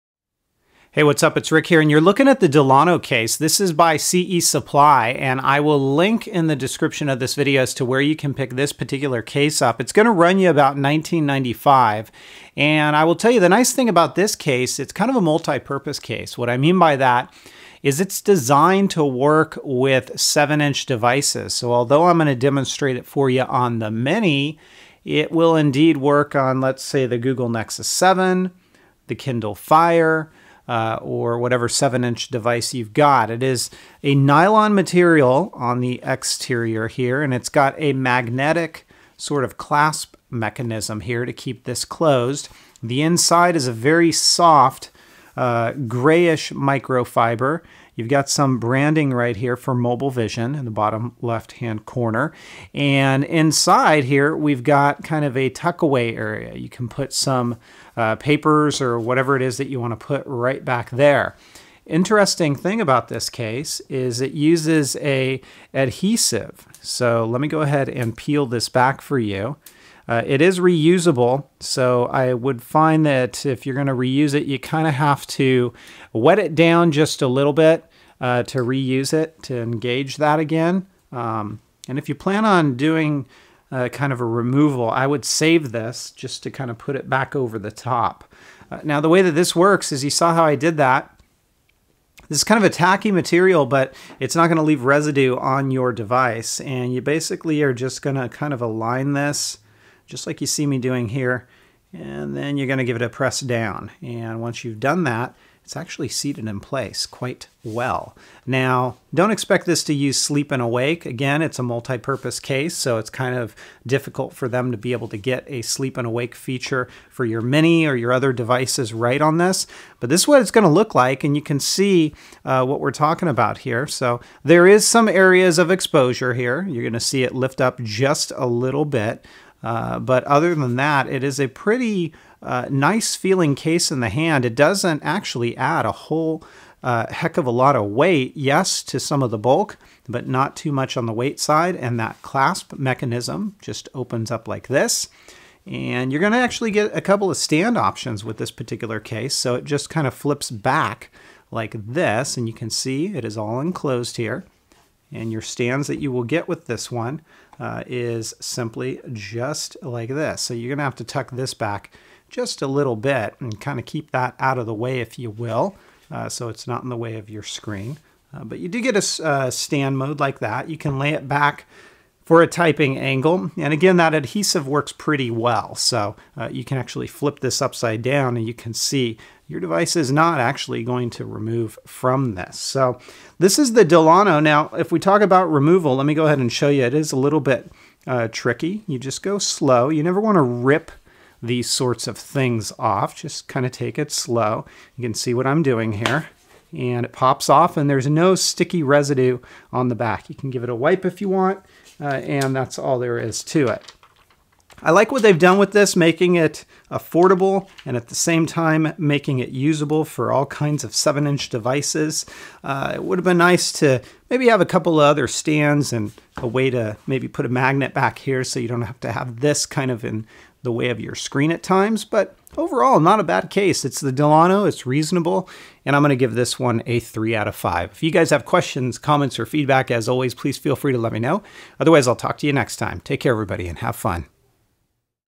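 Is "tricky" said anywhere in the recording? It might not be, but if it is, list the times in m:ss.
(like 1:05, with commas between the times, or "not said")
3:08.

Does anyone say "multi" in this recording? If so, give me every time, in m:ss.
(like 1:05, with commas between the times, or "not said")
0:15, 1:51.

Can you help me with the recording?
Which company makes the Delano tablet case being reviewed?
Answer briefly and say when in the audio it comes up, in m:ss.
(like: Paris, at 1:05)
CE Supply, at 0:03.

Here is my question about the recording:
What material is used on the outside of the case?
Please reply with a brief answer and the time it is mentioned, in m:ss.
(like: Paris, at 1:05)
Nylon, at 0:34.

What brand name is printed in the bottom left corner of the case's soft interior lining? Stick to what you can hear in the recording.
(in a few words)
Mobile Vision.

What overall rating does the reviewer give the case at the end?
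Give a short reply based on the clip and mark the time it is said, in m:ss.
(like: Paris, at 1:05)
3 out of 5, at 3:46.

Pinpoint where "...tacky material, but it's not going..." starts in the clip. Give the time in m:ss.
1:32.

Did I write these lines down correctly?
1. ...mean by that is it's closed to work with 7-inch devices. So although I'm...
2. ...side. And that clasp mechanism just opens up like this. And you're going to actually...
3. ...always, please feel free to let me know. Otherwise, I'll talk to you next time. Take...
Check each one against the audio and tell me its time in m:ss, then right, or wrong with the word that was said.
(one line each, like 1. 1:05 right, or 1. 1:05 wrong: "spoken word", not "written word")
1. 0:16 wrong: "designed", not "closed"
2. 2:21 right
3. 3:50 right.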